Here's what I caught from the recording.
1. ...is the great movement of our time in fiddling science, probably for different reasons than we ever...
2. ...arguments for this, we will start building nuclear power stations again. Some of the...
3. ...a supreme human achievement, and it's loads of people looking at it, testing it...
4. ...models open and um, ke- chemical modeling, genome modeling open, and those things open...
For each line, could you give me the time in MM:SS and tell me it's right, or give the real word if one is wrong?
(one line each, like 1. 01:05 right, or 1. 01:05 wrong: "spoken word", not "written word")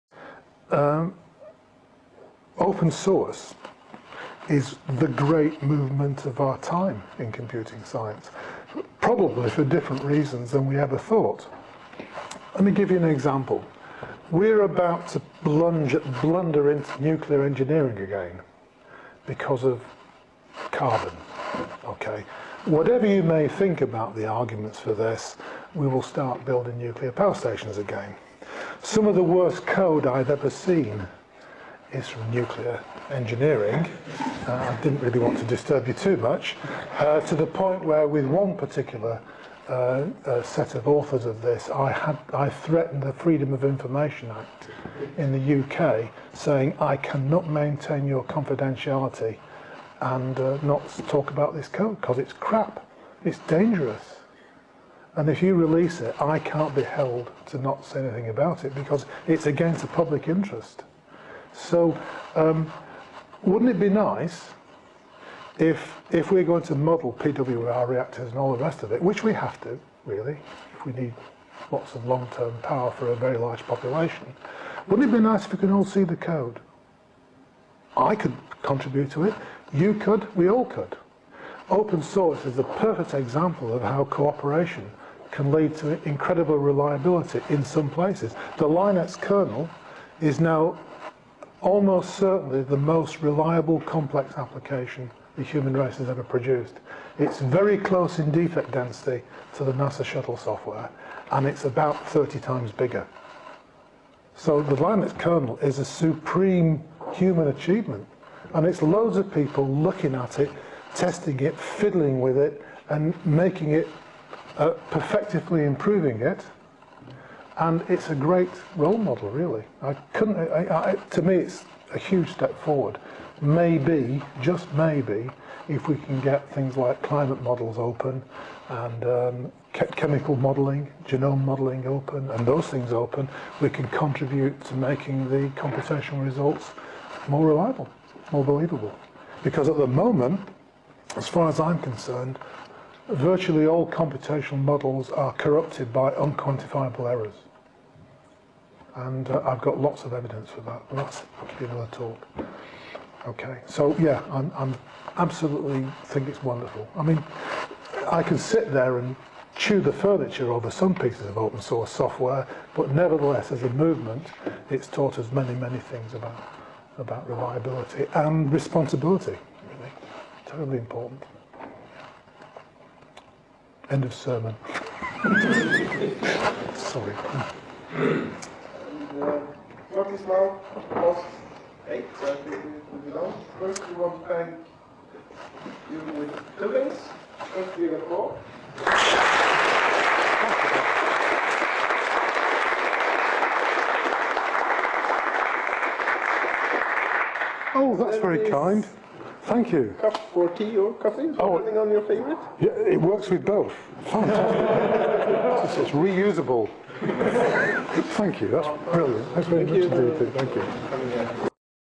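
1. 00:04 wrong: "computing", not "fiddling"
2. 00:24 right
3. 01:45 right
4. 02:07 right.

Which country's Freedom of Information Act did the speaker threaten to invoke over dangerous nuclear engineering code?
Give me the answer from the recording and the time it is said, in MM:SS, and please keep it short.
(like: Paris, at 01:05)
UK, at 00:45.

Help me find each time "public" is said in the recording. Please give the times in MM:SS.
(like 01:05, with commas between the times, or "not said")
00:59.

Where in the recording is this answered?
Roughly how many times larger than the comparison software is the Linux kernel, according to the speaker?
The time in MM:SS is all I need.
01:42.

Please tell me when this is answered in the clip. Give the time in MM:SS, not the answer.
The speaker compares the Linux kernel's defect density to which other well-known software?
01:39.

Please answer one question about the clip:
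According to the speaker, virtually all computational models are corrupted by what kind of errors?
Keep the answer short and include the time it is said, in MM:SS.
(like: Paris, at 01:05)
unquantifiable errors, at 02:26.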